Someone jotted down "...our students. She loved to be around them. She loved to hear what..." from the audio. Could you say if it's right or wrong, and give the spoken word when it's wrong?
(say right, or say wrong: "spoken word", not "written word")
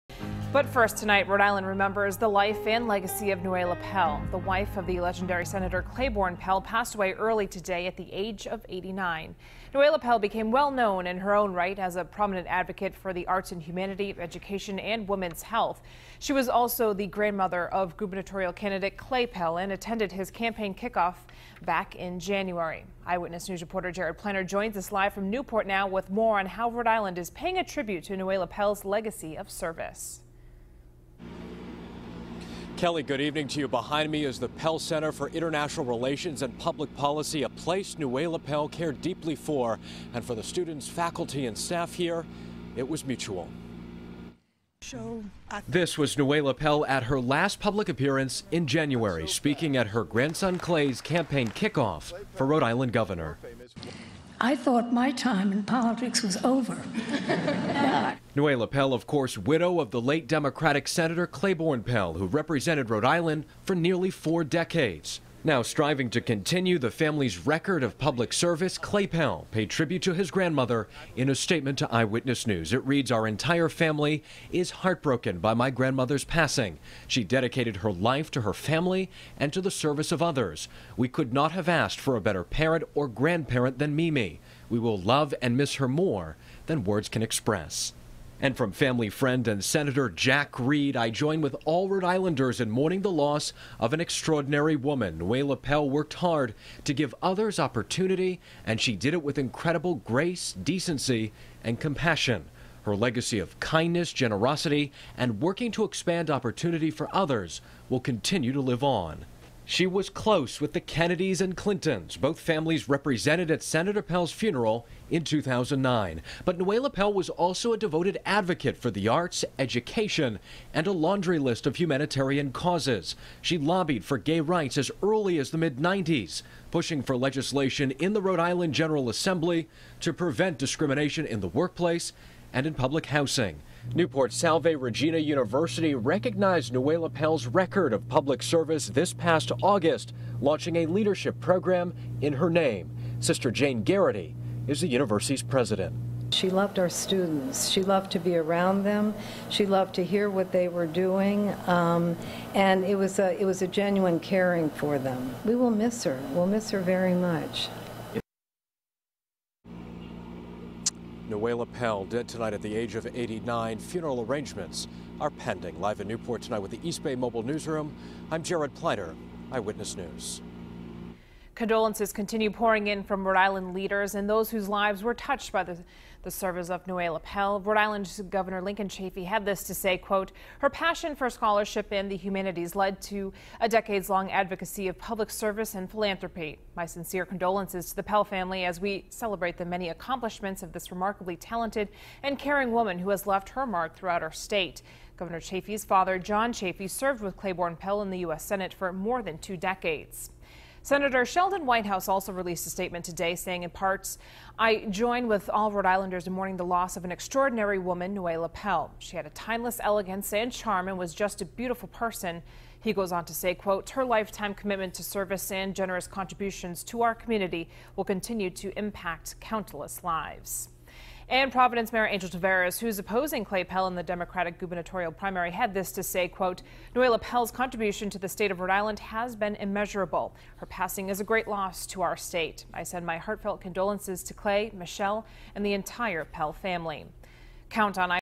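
right.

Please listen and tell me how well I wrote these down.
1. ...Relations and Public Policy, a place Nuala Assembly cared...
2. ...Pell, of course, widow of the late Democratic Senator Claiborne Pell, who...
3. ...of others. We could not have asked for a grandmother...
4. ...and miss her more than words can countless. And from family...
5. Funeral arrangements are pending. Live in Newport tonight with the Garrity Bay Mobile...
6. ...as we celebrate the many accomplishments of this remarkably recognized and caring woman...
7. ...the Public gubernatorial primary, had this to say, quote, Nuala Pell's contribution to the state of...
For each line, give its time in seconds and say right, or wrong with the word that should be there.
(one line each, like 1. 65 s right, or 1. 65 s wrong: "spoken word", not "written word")
1. 35 s wrong: "Pell", not "Assembly"
2. 58 s right
3. 80 s wrong: "better", not "grandmother"
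4. 85 s wrong: "express", not "countless"
5. 163 s wrong: "East", not "Garrity"
6. 188 s wrong: "talented", not "recognized"
7. 223 s wrong: "Democratic", not "Public".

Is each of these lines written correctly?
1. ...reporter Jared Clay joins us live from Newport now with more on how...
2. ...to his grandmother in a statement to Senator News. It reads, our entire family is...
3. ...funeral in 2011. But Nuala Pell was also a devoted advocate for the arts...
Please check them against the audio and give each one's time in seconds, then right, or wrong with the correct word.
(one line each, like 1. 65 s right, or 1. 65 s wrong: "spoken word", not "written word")
1. 23 s wrong: "Pliner", not "Clay"
2. 70 s wrong: "Eyewitness", not "Senator"
3. 114 s wrong: "2009", not "2011".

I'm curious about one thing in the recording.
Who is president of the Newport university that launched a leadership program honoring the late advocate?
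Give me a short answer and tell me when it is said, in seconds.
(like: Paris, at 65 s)
Sister Jane Garrity, at 143 s.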